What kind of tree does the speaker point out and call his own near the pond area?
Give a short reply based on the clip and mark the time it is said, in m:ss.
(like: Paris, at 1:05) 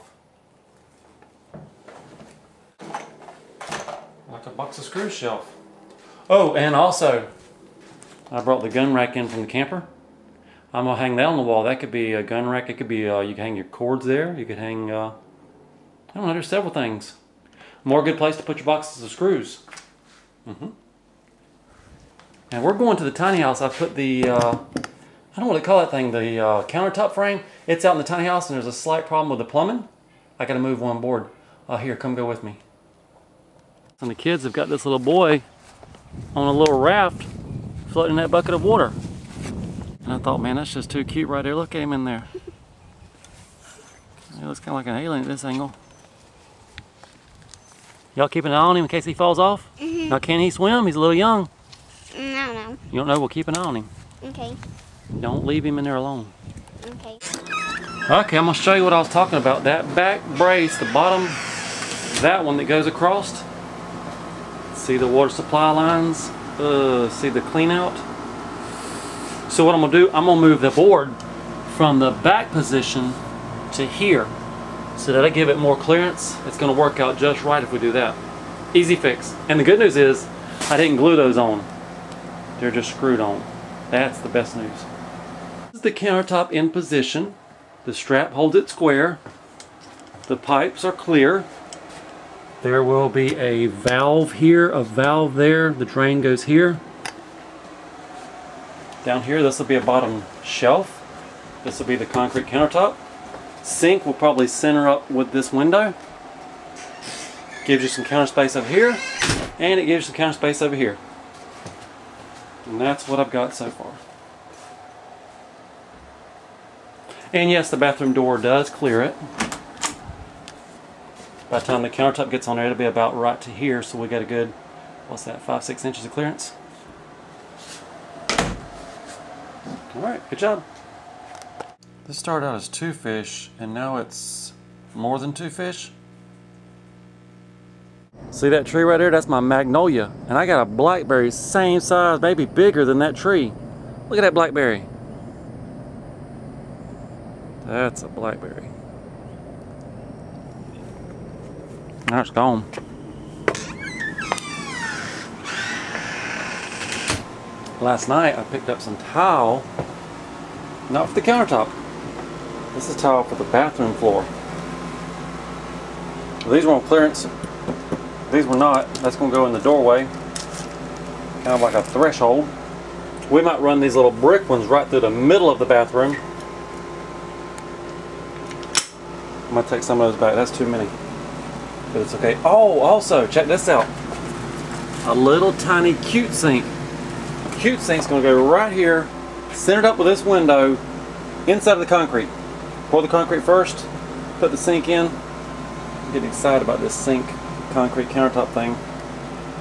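Magnolia, at 2:19.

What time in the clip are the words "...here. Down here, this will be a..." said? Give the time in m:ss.
1:36.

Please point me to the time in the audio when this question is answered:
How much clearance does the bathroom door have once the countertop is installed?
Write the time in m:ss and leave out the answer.
2:05.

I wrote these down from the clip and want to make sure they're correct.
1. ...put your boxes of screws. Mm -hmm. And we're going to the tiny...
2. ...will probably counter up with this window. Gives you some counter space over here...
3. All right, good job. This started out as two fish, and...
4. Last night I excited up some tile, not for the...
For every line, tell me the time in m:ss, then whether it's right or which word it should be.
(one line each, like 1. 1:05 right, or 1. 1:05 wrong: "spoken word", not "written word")
1. 0:18 right
2. 1:44 wrong: "center", not "counter"
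3. 2:09 right
4. 2:37 wrong: "picked", not "excited".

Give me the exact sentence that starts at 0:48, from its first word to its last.
Y'all keep an eye on him in case he falls off?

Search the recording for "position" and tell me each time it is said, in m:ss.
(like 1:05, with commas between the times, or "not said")
1:12, 1:26.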